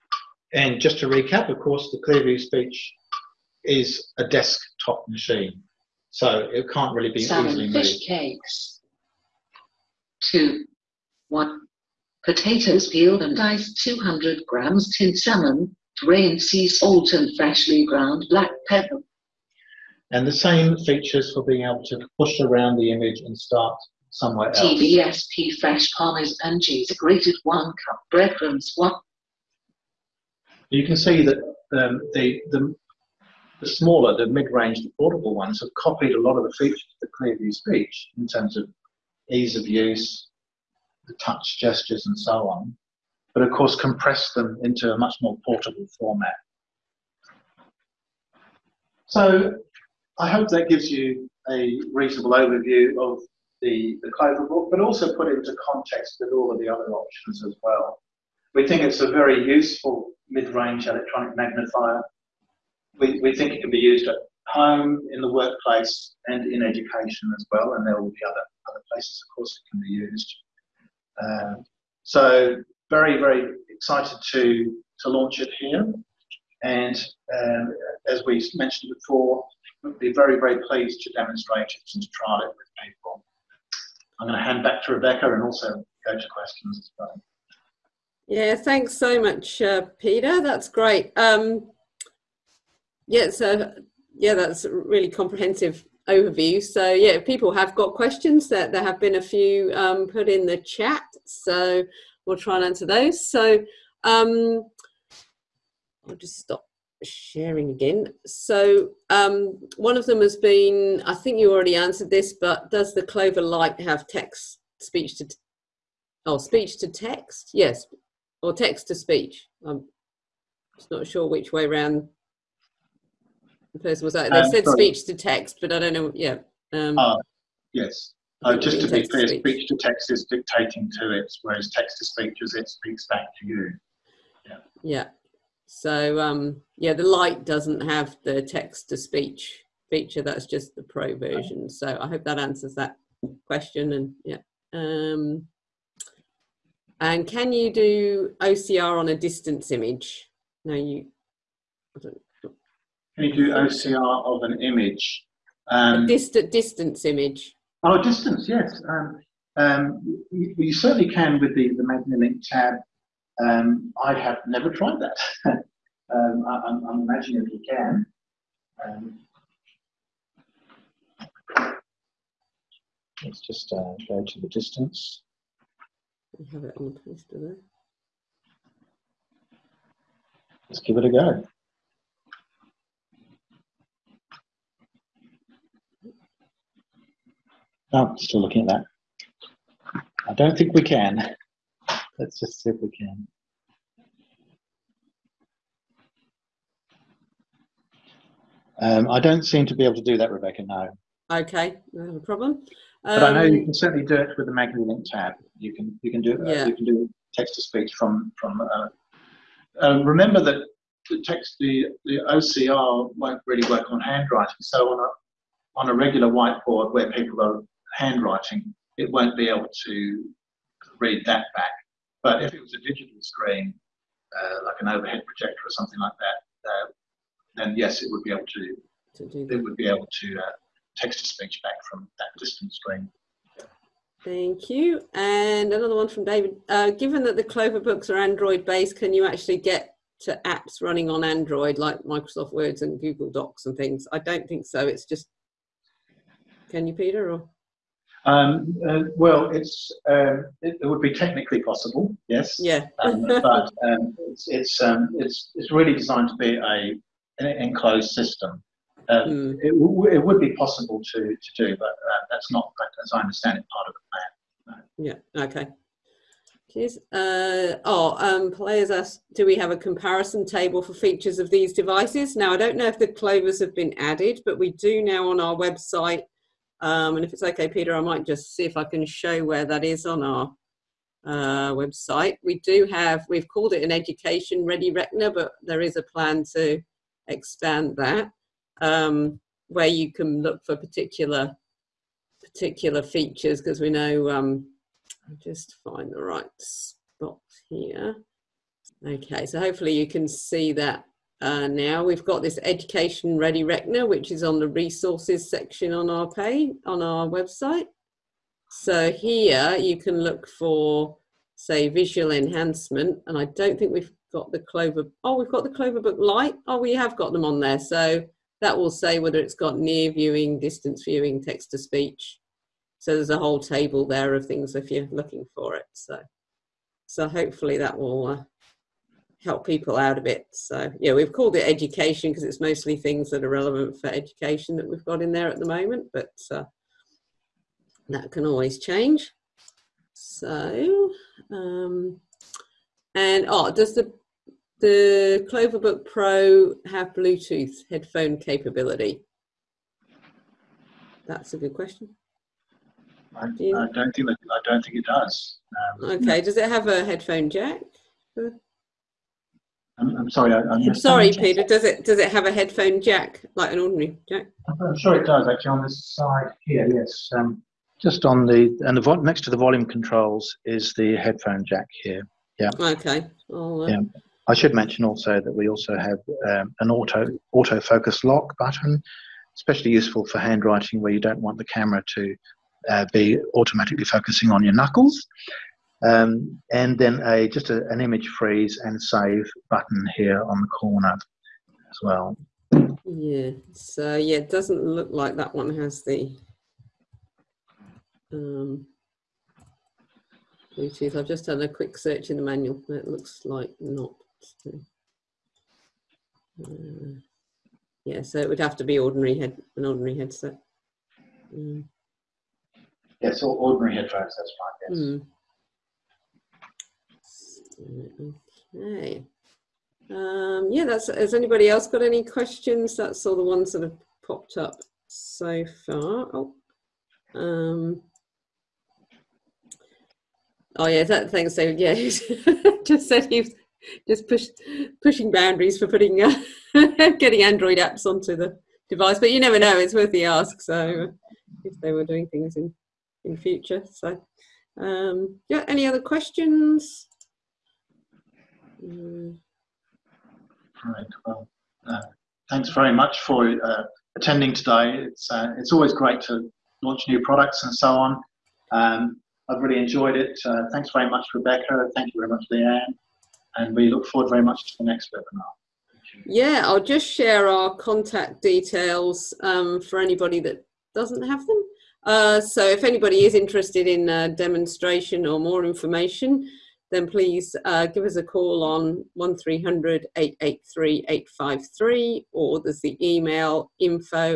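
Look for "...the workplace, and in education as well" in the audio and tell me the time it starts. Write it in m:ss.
1:05.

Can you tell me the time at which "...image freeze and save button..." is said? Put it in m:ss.
6:28.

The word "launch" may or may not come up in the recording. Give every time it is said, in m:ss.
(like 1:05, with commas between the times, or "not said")
1:15, 7:36.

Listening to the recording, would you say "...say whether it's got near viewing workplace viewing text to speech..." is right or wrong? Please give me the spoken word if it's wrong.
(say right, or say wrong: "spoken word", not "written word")
wrong: "distance", not "workplace".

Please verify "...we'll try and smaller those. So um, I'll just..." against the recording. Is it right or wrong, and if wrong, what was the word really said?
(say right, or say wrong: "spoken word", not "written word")
wrong: "answer", not "smaller".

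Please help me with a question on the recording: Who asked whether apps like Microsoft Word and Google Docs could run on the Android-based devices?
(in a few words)
David.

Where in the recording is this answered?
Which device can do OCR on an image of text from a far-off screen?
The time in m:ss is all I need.
2:41.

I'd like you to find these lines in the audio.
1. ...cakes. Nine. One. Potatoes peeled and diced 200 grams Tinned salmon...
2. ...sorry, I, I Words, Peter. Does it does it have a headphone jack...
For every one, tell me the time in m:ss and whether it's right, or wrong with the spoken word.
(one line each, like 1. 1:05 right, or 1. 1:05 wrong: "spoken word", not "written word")
1. 0:08 wrong: "Two", not "Nine"
2. 6:00 wrong: "Sorry", not "Words".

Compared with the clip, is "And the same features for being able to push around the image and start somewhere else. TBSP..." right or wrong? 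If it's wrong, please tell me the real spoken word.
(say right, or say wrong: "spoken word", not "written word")
right.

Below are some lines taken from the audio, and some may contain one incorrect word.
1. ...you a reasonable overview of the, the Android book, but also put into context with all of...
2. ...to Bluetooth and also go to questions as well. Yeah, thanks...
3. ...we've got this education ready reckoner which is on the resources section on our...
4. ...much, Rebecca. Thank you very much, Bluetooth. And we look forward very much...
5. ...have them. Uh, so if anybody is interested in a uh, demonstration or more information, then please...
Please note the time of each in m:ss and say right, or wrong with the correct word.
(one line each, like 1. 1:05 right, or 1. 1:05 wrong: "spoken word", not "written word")
1. 0:50 wrong: "Clover", not "Android"
2. 1:24 wrong: "Rebecca", not "Bluetooth"
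3. 5:02 right
4. 7:41 wrong: "Leanne", not "Bluetooth"
5. 7:51 right.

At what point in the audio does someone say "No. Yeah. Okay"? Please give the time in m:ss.
4:25.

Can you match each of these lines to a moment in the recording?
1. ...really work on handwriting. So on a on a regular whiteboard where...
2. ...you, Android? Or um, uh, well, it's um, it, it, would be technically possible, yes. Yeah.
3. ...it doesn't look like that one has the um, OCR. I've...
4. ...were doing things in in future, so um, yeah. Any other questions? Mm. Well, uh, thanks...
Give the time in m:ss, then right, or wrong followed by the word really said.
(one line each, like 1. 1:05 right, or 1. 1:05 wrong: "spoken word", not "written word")
1. 3:33 right
2. 4:06 wrong: "Peter", not "Android"
3. 6:34 wrong: "Bluetooth", not "OCR"
4. 7:21 right.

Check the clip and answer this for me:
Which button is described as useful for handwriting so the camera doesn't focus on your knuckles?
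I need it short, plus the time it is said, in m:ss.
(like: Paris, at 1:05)
Autofocus lock, at 6:17.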